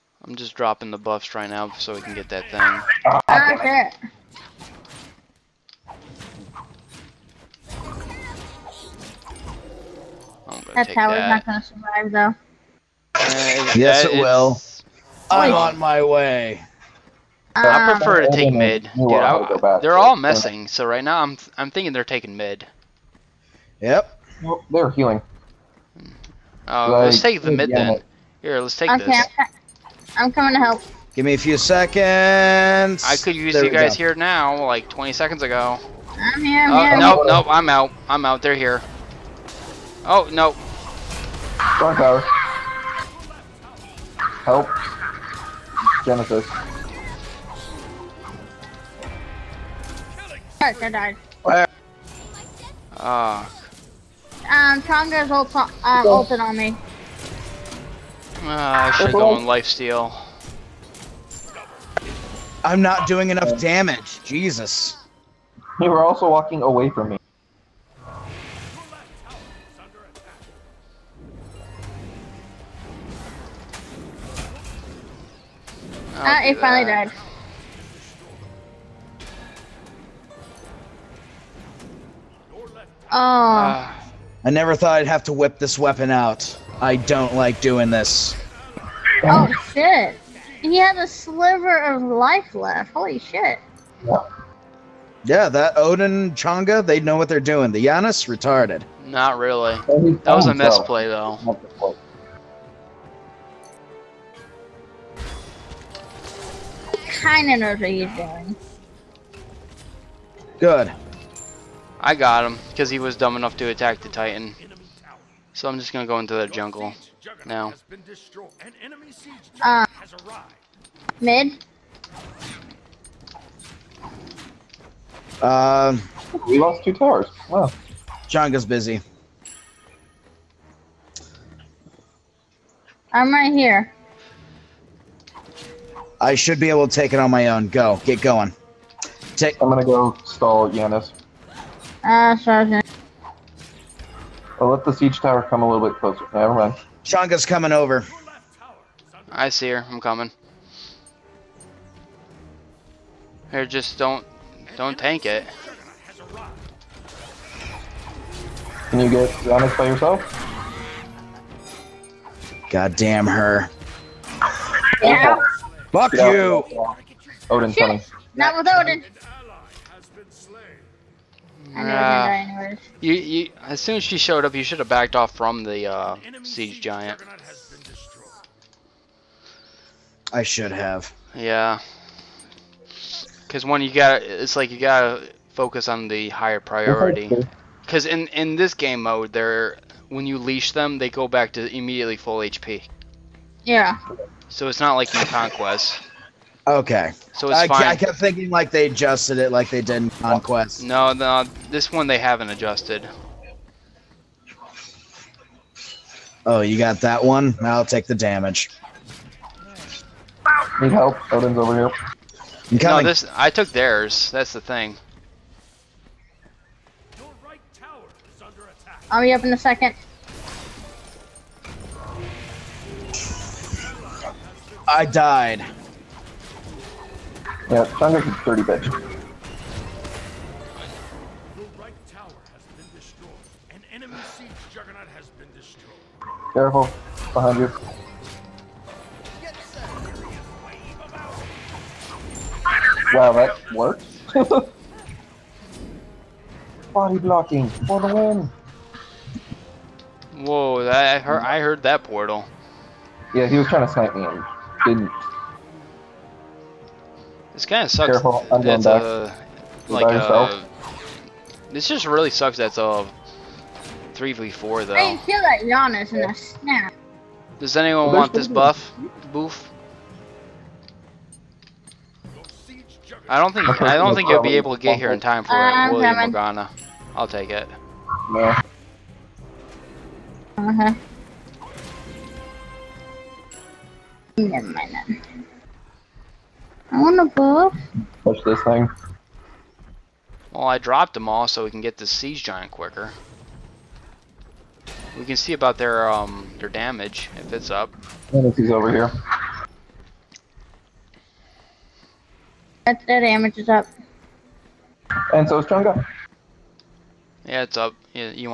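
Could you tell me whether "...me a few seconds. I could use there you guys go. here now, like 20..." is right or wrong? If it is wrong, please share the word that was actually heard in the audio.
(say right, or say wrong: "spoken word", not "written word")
right.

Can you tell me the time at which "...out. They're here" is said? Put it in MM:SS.
00:38.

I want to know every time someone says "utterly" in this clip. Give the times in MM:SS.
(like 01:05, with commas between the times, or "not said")
not said.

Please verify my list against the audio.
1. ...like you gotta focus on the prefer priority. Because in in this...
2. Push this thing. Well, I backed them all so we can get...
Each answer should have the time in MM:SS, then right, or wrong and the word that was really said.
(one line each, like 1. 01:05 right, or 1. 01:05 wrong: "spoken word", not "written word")
1. 03:04 wrong: "higher", not "prefer"
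2. 04:48 wrong: "dropped", not "backed".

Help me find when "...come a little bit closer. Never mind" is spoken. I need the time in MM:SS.
02:25.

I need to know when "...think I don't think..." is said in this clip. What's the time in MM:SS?
04:33.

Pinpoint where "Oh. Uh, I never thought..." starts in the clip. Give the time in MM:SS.
01:23.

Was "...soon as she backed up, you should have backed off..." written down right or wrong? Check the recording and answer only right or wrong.
wrong.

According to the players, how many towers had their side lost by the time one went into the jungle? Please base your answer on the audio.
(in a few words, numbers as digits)
2.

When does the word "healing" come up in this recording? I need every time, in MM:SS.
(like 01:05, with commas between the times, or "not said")
00:24.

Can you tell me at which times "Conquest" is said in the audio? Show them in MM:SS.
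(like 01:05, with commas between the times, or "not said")
03:15, 03:20.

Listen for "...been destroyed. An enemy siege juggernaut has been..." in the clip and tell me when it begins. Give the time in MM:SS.
03:52.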